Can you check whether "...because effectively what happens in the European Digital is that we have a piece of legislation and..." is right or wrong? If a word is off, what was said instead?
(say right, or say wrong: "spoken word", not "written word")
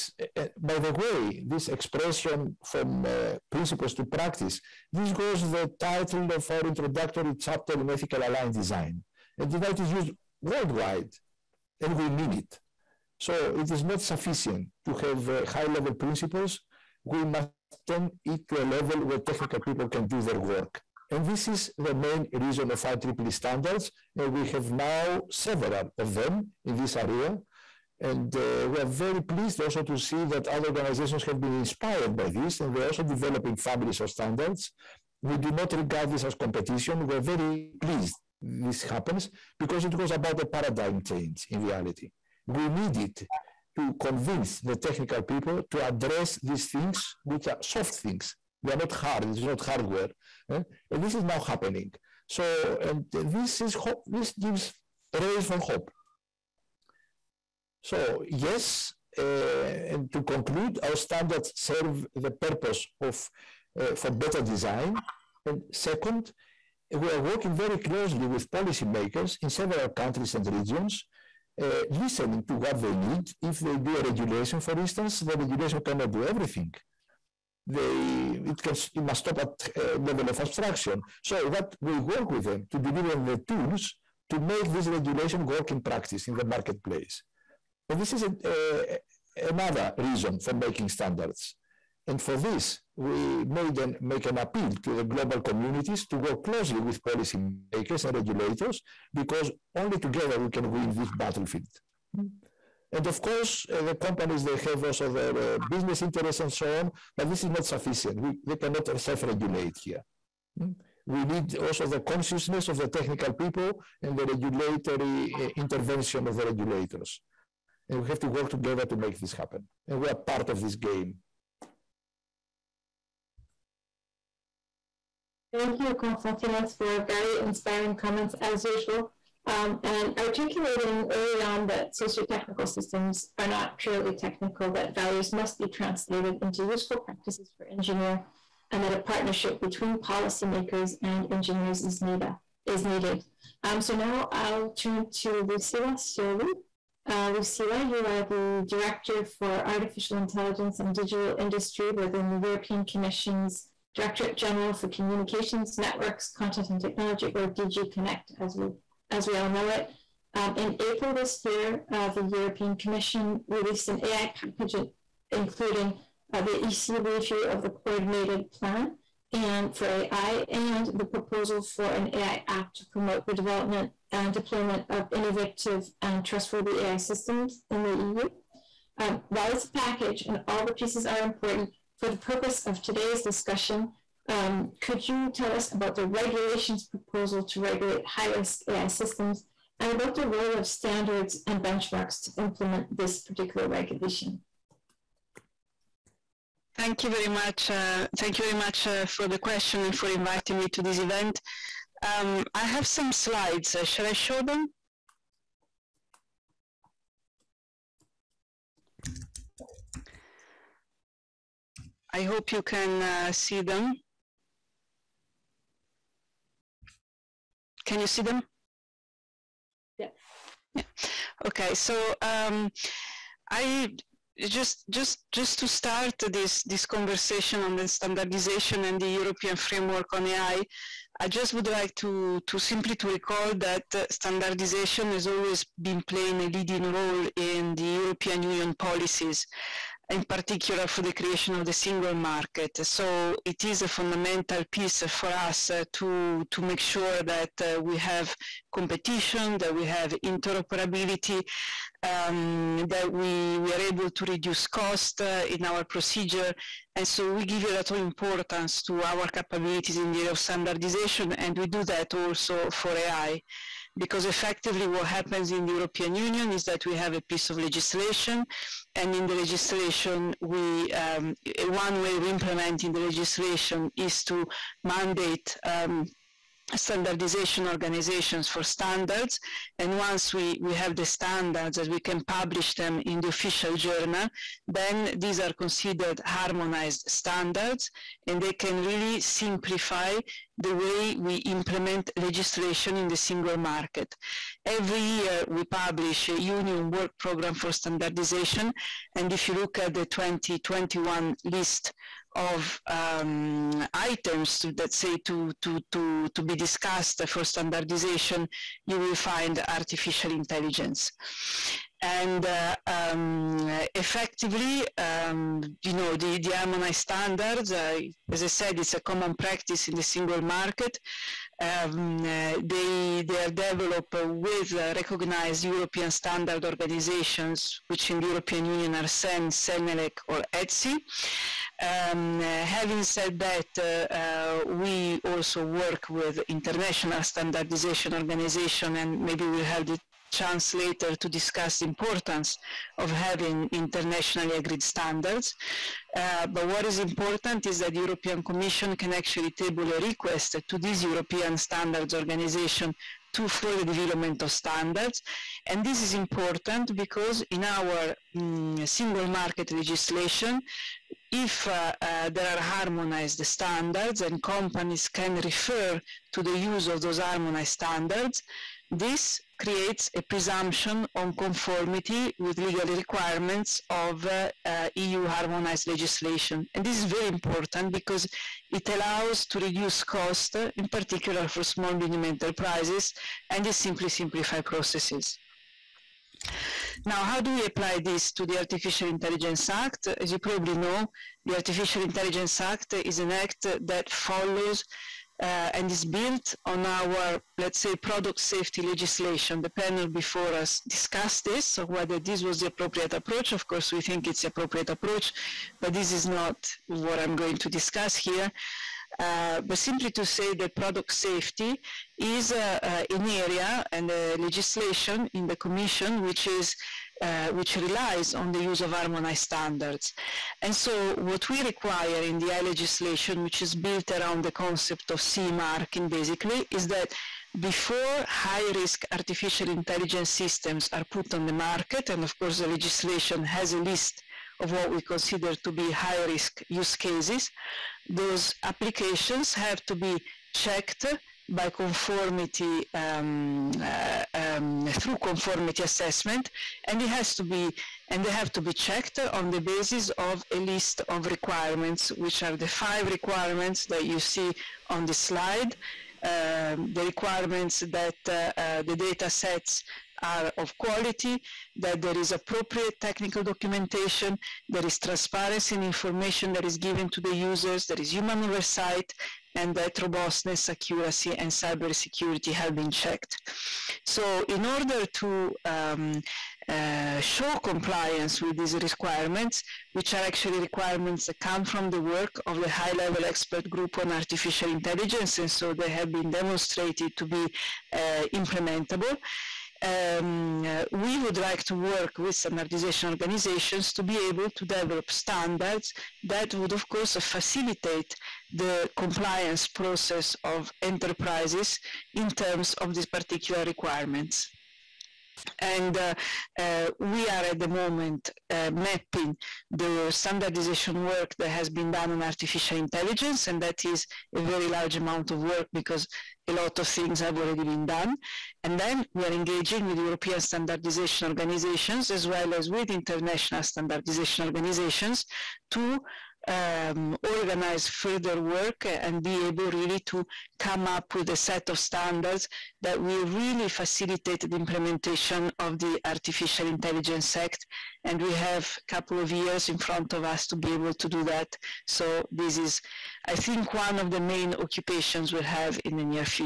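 wrong: "Union", not "Digital".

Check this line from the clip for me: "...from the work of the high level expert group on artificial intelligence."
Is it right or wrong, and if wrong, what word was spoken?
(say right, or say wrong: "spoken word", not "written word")
right.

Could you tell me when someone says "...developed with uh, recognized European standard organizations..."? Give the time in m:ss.
5:23.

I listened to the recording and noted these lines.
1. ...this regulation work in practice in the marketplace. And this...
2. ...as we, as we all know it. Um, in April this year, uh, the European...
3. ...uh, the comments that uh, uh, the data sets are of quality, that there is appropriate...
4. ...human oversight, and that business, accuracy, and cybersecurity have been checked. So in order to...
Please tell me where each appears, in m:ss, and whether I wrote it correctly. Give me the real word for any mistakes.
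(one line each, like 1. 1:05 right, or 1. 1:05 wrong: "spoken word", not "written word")
1. 1:24 right
2. 2:38 right
3. 7:36 wrong: "requirements", not "comments"
4. 7:48 wrong: "robustness", not "business".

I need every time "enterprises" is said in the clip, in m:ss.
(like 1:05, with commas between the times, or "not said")
6:22, 8:20.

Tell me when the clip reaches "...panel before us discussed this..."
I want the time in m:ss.
6:39.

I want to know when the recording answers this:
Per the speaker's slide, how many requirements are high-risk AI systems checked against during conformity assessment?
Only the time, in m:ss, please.
7:32.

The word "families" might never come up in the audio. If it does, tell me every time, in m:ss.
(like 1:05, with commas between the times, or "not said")
0:33.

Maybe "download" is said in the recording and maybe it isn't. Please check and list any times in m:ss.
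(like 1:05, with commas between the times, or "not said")
not said.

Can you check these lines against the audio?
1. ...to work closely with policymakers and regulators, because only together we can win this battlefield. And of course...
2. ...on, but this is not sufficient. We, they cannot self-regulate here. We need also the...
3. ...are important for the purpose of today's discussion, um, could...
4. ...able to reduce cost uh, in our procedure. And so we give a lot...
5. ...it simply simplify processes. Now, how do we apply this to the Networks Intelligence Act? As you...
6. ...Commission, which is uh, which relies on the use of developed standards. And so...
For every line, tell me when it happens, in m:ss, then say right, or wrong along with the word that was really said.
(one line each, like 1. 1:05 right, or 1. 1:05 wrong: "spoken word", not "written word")
1. 1:36 right
2. 1:46 right
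3. 3:01 right
4. 4:13 right
5. 6:23 wrong: "Artificial", not "Networks"
6. 6:55 wrong: "harmonized", not "developed".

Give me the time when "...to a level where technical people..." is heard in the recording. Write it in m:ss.
0:18.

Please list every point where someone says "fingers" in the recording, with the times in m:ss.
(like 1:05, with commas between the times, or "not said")
not said.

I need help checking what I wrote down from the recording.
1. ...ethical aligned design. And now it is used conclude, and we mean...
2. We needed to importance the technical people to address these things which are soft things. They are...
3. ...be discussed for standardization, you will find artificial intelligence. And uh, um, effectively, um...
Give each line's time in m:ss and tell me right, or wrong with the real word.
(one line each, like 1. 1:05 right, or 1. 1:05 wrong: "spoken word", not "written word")
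1. 0:07 wrong: "worldwide", not "conclude"
2. 0:42 wrong: "convince", not "importance"
3. 5:06 right.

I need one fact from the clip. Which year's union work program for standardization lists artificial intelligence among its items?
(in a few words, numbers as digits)
2021.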